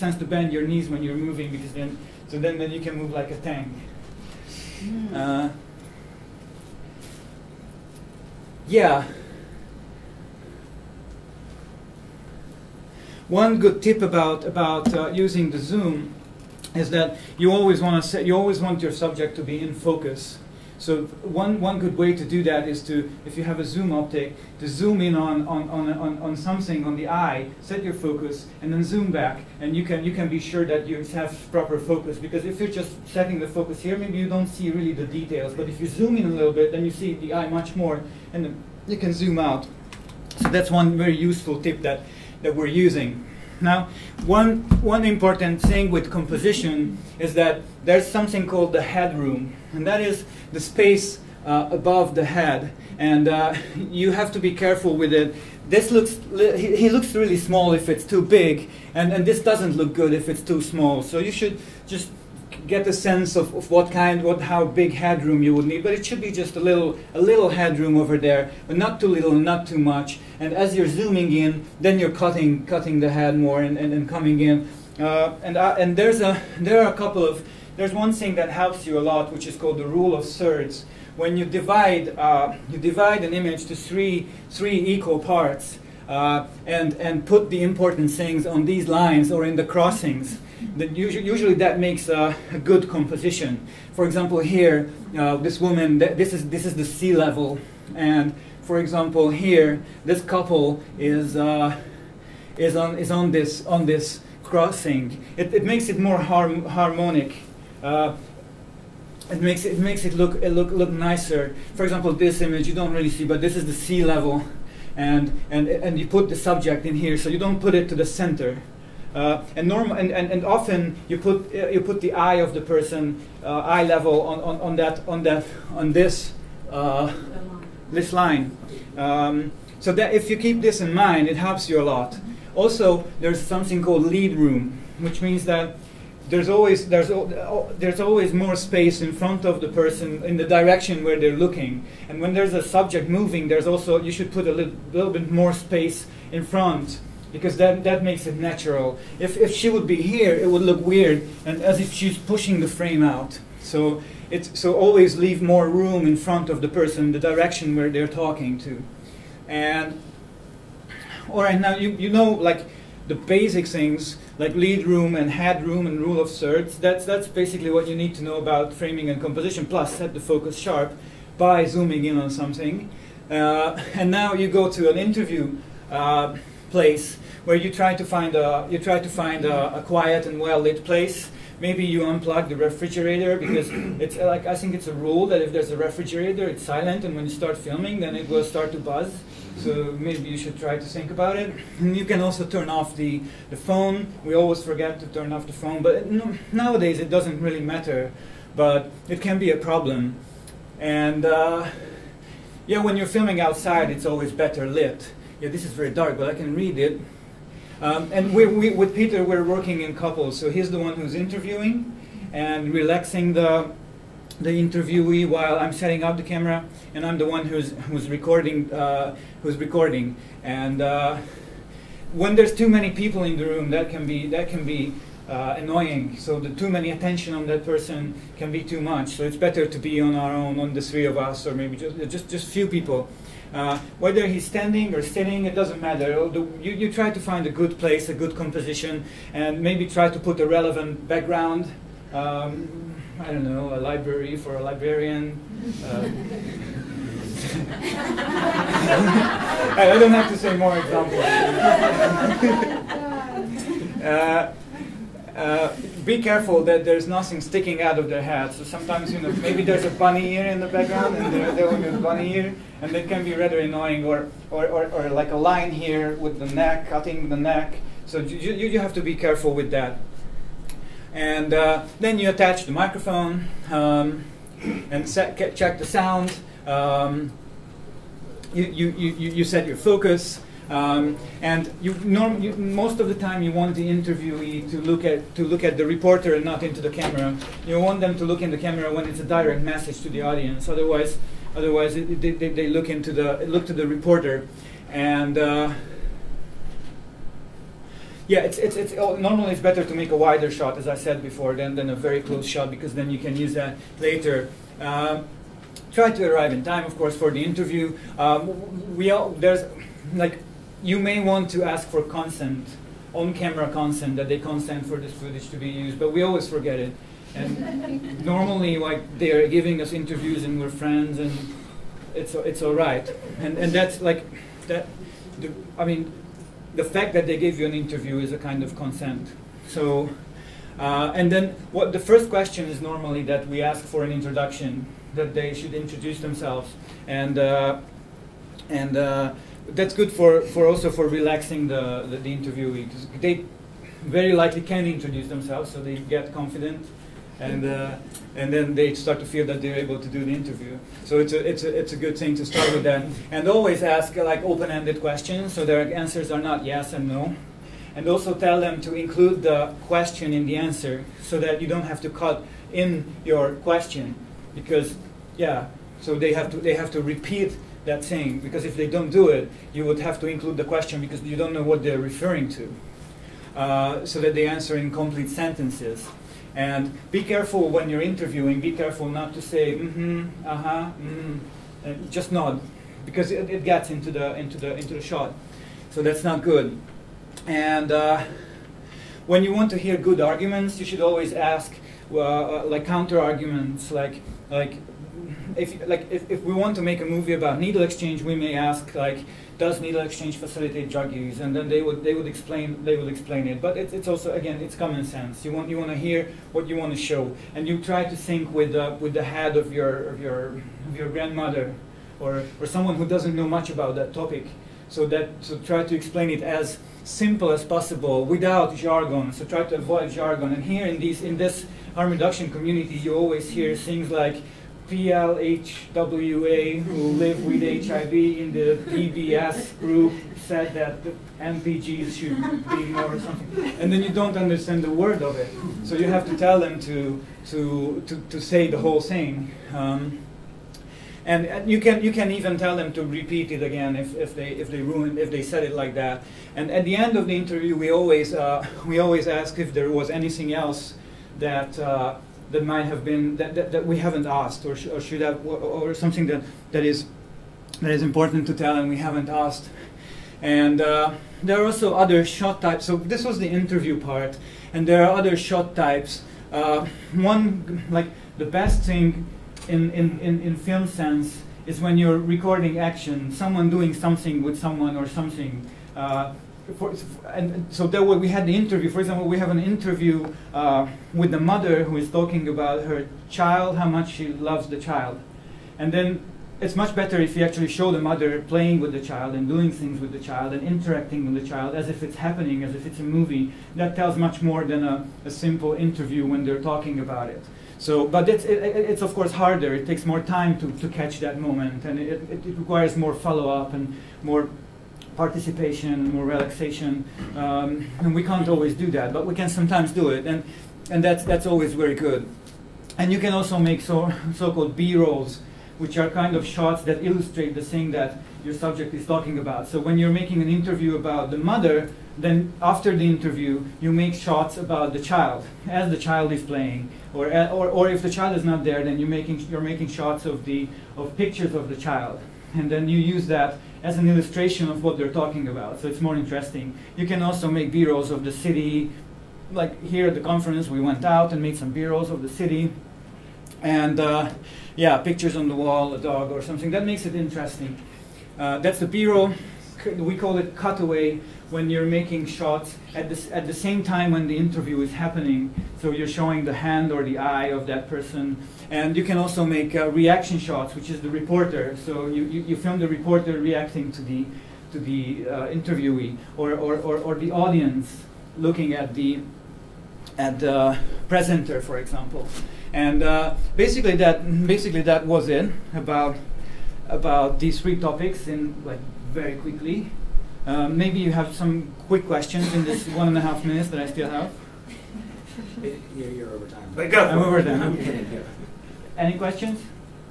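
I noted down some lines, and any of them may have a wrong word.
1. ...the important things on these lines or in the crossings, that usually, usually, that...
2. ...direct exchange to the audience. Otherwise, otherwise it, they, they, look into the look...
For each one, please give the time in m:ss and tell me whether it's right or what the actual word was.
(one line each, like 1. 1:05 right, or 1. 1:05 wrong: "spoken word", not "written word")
1. 1:27 right
2. 4:49 wrong: "message", not "exchange".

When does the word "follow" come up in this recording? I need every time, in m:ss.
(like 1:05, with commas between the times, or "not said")
8:23.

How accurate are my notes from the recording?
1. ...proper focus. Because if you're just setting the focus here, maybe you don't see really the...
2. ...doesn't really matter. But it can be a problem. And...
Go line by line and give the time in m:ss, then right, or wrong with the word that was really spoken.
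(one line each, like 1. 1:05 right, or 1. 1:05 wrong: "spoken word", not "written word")
1. 0:31 right
2. 3:17 right.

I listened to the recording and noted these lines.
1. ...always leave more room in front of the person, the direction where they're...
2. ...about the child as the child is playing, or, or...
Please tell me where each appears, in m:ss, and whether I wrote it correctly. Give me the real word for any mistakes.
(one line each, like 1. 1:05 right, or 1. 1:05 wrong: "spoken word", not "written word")
1. 2:34 right
2. 8:44 right.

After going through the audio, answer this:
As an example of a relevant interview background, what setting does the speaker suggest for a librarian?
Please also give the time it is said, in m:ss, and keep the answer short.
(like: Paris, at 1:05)
A library, at 4:03.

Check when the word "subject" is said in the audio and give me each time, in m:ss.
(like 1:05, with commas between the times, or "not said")
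0:18, 1:56, 2:22, 8:38.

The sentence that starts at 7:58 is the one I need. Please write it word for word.
For example, we have an interview uh, with the mother who is talking about her child, how much she loves the child.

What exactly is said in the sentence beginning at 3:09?
So maybe you should try to think about it.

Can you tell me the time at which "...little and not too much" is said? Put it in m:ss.
1:09.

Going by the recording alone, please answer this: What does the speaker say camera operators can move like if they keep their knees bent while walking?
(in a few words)
A tank.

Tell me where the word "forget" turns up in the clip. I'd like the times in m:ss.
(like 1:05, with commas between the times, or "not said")
3:14, 5:16.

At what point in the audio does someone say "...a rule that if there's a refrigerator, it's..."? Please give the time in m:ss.
3:04.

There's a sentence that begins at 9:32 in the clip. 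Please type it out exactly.
And uh, basically, that, basically that was it about, about these three topics in like very quickly.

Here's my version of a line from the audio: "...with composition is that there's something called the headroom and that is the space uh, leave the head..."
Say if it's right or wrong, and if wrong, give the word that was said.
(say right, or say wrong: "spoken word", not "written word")
wrong: "above", not "leave".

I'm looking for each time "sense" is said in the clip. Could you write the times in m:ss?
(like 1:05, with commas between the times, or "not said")
1:02, 6:45, 7:50.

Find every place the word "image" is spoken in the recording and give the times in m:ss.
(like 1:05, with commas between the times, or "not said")
1:23, 1:52.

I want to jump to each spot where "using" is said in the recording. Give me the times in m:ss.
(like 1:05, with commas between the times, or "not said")
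0:15, 0:42.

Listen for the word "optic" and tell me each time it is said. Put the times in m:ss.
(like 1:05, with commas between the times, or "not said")
0:23.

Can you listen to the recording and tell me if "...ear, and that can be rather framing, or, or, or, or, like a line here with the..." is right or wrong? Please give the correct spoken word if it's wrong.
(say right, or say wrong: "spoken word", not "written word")
wrong: "annoying", not "framing".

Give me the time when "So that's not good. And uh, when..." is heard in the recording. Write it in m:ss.
6:25.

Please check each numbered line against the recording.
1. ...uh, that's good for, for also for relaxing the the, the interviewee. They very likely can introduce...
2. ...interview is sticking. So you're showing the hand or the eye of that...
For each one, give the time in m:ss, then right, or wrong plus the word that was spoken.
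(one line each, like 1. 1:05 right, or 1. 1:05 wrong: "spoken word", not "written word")
1. 5:38 right
2. 9:14 wrong: "happening", not "sticking".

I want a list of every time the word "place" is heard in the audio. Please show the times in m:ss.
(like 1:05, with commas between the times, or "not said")
2:56, 3:00, 3:57.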